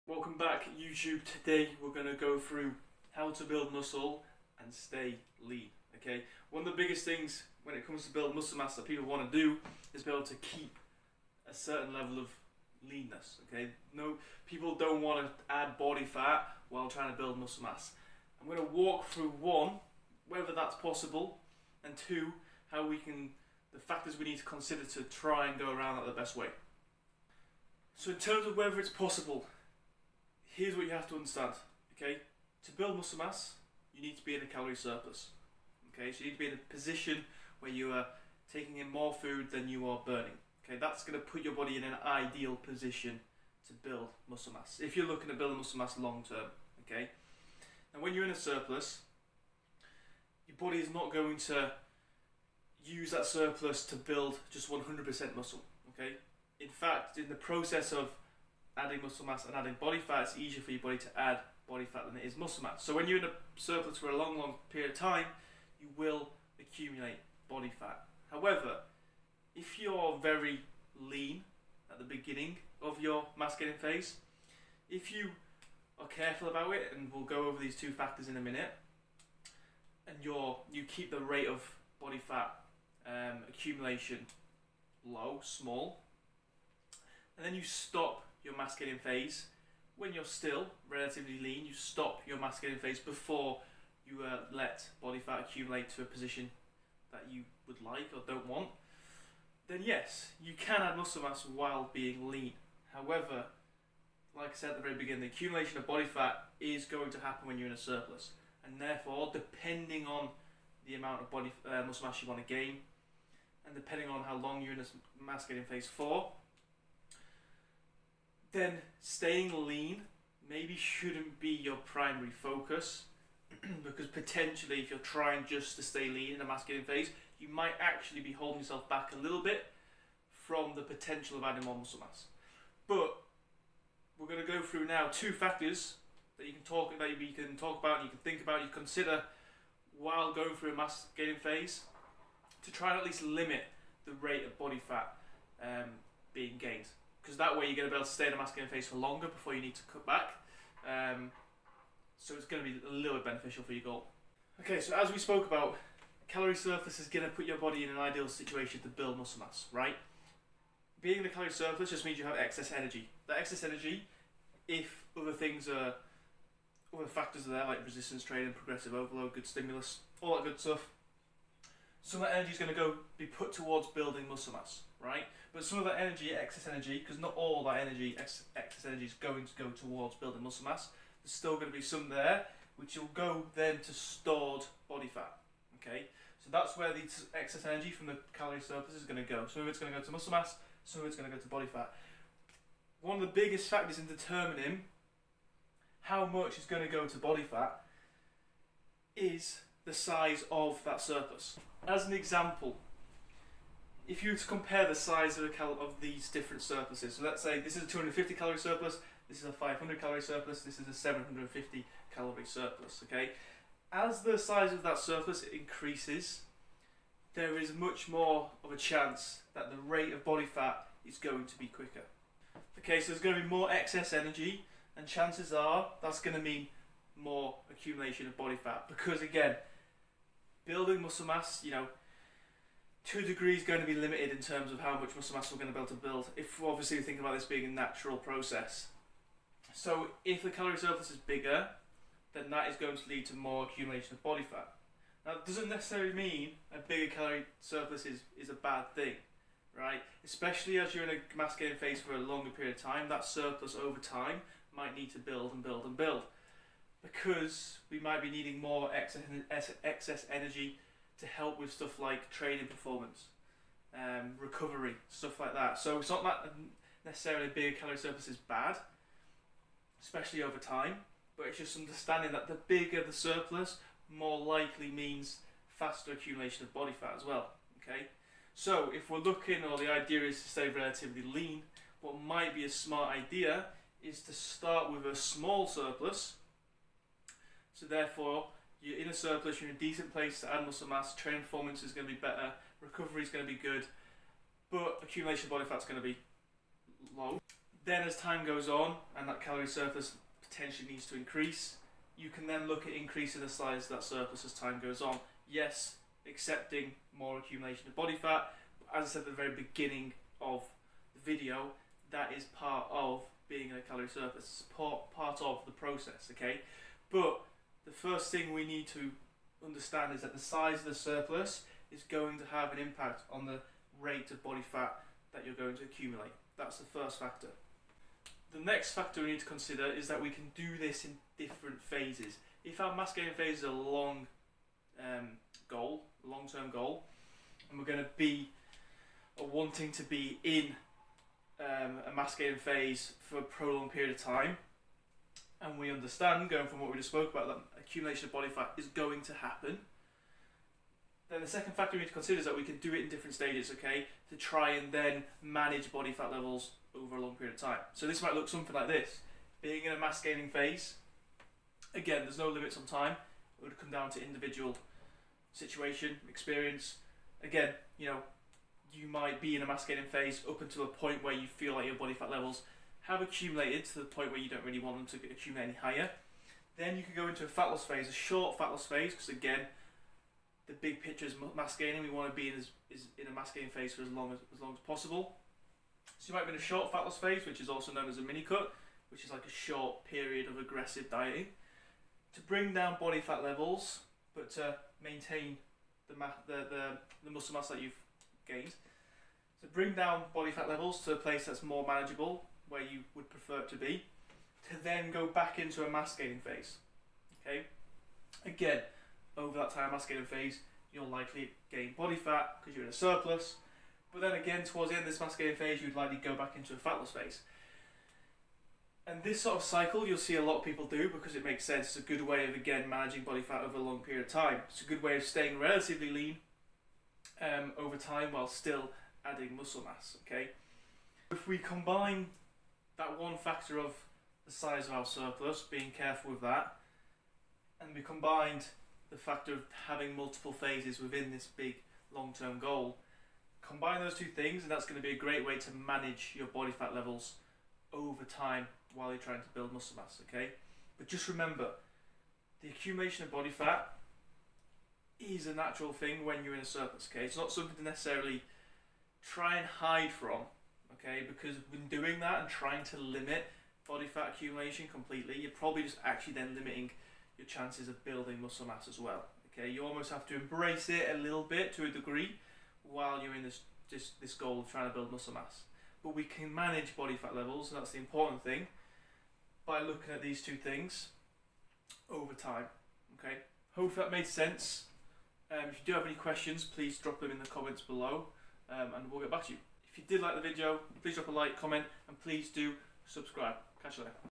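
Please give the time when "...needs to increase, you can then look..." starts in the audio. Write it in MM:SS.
05:00.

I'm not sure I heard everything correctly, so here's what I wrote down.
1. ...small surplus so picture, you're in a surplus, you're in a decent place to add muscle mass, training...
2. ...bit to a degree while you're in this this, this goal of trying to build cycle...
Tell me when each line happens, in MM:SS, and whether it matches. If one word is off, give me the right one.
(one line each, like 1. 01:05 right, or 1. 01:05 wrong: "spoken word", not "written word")
1. 04:45 wrong: "therefore", not "picture"
2. 07:51 wrong: "muscle", not "cycle".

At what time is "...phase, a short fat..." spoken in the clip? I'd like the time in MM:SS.
06:17.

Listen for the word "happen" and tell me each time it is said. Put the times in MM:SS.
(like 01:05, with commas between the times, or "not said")
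01:47, 05:49.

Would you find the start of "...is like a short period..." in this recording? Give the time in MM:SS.
06:29.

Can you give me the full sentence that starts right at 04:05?
Now, that doesn't necessarily mean a bigger calorie surplus is, is a bad thing, right?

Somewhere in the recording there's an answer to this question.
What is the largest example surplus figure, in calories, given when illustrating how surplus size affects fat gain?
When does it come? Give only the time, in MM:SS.
03:30.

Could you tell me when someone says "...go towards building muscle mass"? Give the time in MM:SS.
02:59.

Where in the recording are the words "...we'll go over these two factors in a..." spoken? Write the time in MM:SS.
01:17.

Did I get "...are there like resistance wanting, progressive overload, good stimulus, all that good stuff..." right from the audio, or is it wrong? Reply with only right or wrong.
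wrong.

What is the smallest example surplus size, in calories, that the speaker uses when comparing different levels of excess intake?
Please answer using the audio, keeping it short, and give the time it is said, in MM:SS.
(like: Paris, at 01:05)
250, at 03:27.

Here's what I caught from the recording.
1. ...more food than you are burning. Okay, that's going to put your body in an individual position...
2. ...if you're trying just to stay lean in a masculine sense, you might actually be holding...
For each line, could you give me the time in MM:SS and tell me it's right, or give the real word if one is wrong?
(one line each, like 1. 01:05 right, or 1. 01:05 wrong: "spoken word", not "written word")
1. 00:38 wrong: "ideal", not "individual"
2. 02:04 wrong: "phase", not "sense".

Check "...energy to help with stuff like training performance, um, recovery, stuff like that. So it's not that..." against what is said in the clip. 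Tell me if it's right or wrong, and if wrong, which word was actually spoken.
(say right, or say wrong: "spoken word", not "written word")
right.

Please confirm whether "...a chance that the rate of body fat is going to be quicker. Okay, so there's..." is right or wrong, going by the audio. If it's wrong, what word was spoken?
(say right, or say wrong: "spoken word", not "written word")
right.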